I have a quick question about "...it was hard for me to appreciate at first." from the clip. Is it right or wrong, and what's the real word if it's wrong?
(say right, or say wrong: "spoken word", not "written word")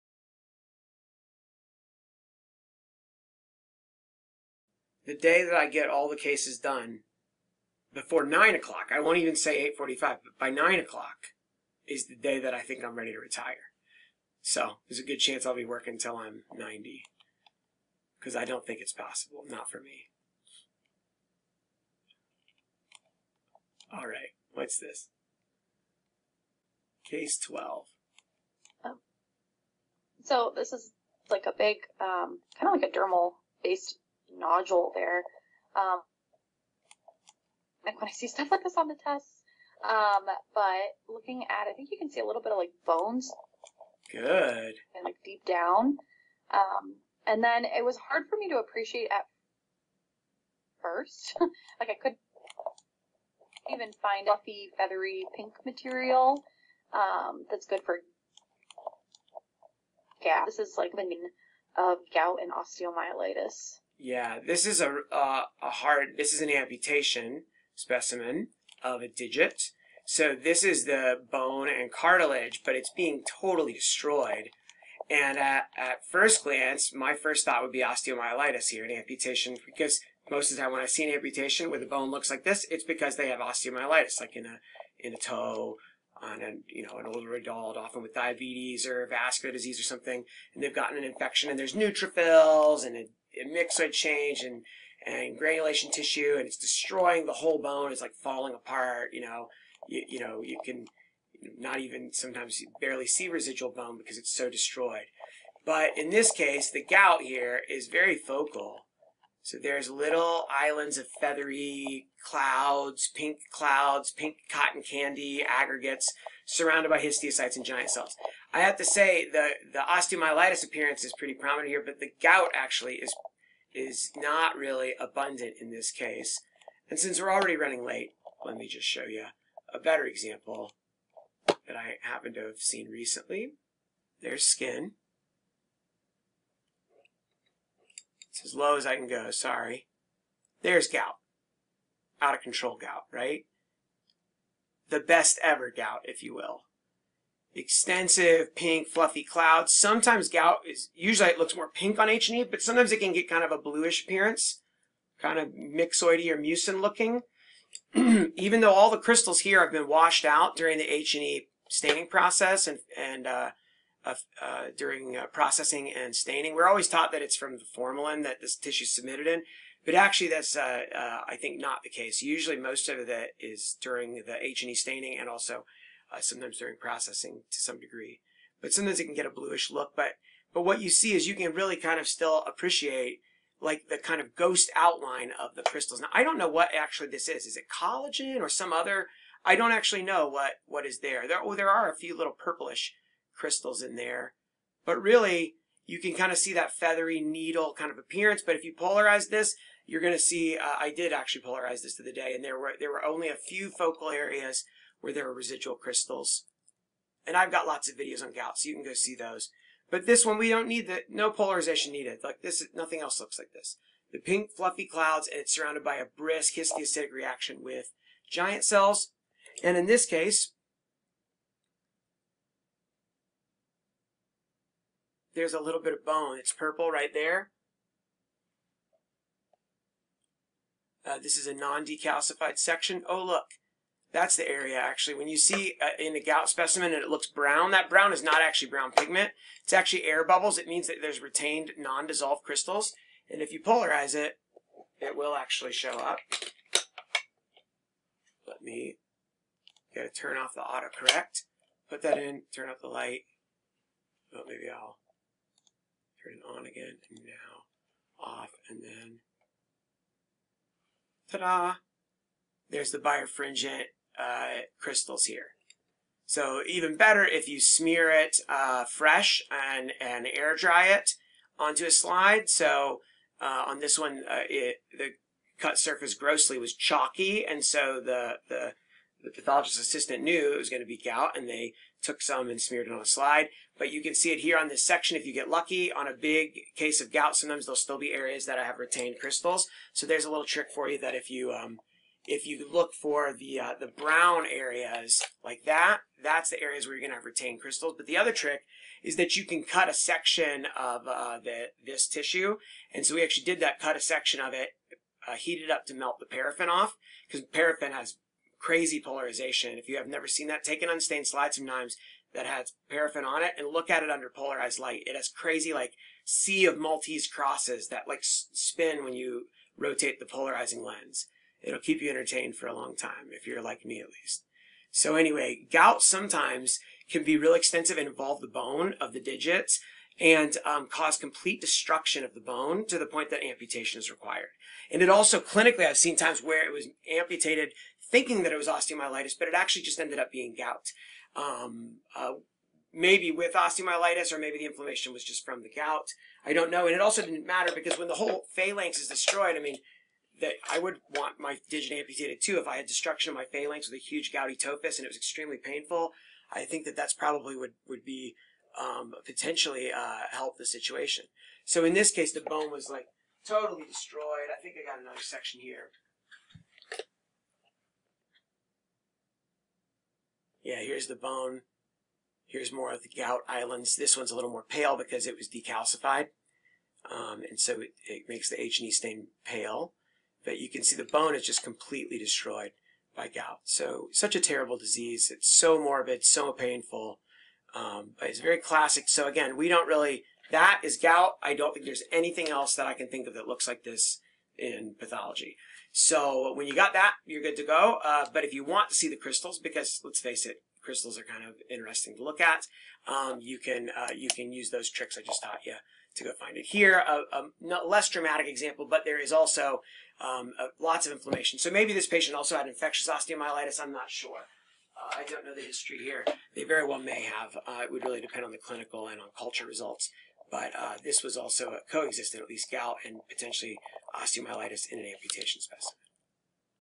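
right.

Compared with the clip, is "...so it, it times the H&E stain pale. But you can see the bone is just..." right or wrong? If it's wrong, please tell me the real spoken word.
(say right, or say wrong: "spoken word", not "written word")
wrong: "makes", not "times".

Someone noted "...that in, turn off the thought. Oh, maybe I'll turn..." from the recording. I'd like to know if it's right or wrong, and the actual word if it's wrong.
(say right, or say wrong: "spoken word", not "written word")
wrong: "light", not "thought".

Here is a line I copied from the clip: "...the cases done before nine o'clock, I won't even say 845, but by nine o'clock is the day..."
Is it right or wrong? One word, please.
right.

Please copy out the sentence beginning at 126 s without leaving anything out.
And since we're already running late, let me just show you a better example that I happen to have seen recently.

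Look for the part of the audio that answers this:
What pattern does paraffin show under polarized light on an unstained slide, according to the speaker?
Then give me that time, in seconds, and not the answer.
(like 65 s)
316 s.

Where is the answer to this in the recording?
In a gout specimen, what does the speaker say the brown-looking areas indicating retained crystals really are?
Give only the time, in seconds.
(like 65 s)
240 s.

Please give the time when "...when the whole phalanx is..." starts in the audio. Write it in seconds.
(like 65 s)
347 s.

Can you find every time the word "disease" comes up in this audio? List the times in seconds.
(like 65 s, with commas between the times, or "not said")
89 s, 384 s.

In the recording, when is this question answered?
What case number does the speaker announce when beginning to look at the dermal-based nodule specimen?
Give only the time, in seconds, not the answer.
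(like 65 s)
27 s.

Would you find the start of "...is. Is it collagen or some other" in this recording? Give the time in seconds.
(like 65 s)
187 s.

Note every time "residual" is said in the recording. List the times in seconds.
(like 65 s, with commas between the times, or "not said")
103 s, 205 s.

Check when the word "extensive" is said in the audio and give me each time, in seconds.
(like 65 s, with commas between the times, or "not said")
147 s, 327 s.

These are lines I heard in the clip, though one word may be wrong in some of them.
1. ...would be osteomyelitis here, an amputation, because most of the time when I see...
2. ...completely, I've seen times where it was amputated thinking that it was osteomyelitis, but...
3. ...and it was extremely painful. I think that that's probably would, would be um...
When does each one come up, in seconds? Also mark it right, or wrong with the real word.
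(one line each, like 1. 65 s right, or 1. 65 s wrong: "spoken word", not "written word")
1. 77 s right
2. 335 s wrong: "clinically", not "completely"
3. 354 s right.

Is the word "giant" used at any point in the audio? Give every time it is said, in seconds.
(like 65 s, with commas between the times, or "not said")
117 s, 218 s.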